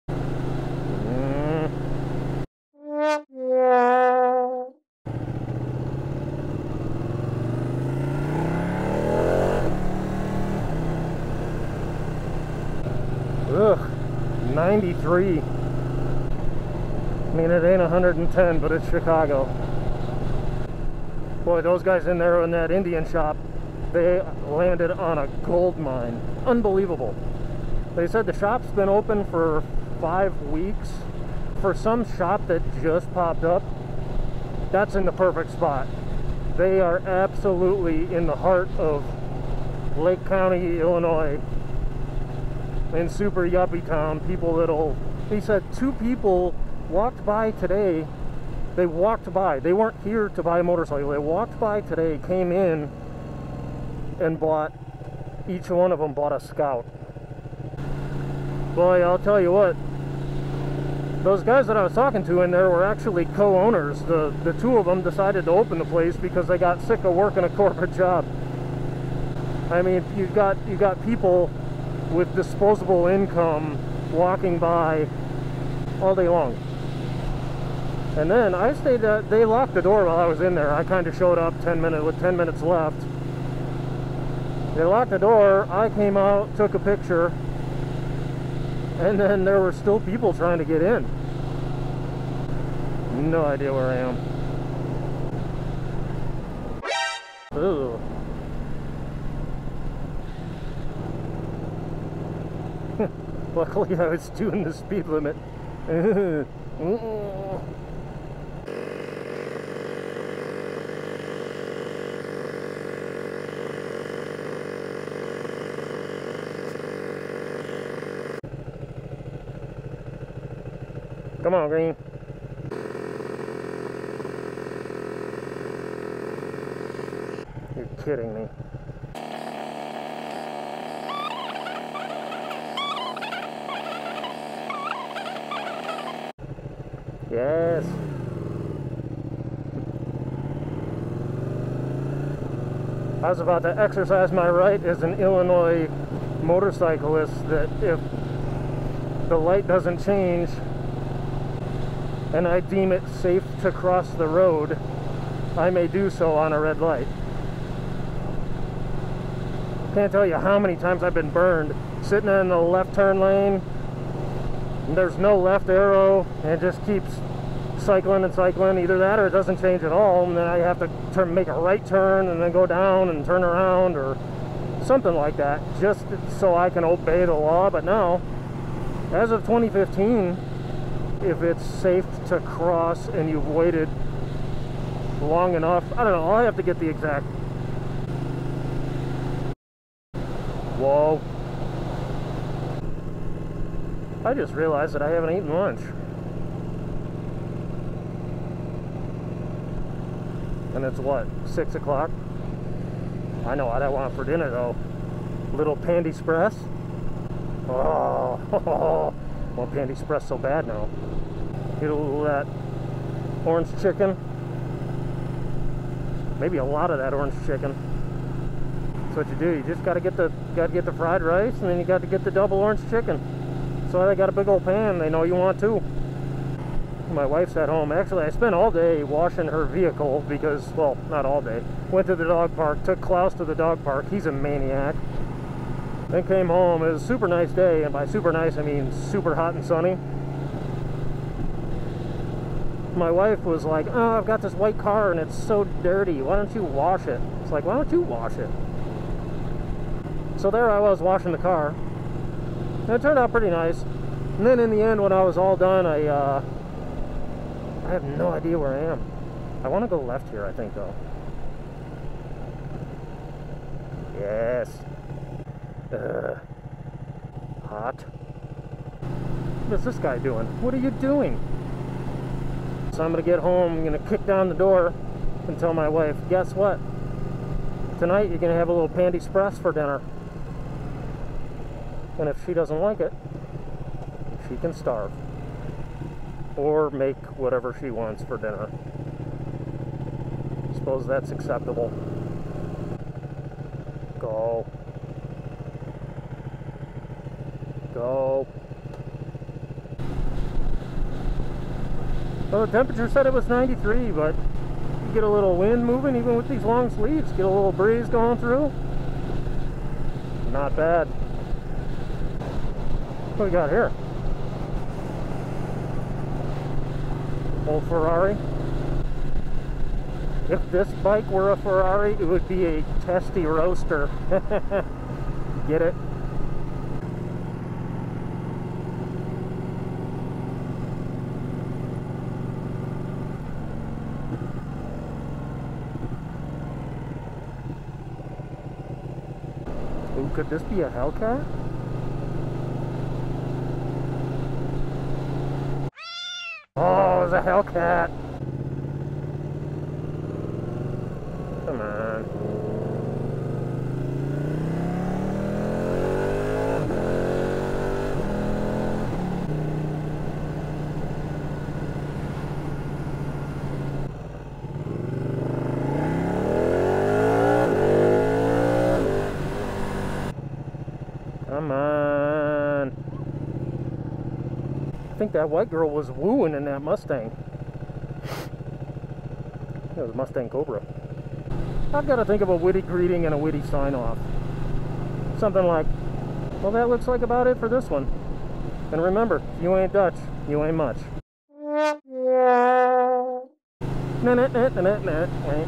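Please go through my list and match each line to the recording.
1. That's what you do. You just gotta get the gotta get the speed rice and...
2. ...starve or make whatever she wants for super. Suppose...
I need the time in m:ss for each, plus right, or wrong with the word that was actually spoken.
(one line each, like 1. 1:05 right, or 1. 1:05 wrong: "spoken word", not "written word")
1. 3:39 wrong: "fried", not "speed"
2. 4:44 wrong: "dinner", not "super".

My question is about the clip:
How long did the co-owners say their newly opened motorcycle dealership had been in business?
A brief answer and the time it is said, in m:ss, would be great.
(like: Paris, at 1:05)
5 weeks, at 0:29.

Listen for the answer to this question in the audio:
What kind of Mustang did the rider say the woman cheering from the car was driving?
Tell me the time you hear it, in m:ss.
6:20.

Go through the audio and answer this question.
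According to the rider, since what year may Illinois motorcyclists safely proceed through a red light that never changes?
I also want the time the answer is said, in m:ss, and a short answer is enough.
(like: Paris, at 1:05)
2015, at 2:59.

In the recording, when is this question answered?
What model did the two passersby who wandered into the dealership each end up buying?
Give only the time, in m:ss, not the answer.
0:56.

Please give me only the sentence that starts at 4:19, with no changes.
I want to go left here, I think, though.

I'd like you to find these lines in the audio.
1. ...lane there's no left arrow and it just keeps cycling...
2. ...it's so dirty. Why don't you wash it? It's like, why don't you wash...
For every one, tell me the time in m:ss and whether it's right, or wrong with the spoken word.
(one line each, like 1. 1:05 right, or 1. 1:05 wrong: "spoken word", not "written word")
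1. 2:43 right
2. 4:05 right.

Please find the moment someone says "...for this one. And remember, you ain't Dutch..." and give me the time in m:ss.
6:27.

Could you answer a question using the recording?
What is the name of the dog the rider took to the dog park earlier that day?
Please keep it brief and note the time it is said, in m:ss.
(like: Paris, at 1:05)
Klaus, at 3:53.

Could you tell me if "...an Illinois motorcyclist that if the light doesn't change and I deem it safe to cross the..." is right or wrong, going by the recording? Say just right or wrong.
right.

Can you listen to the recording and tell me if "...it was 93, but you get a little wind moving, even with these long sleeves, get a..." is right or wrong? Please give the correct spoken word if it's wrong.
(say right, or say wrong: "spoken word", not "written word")
right.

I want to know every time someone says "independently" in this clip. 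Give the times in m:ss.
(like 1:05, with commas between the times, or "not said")
not said.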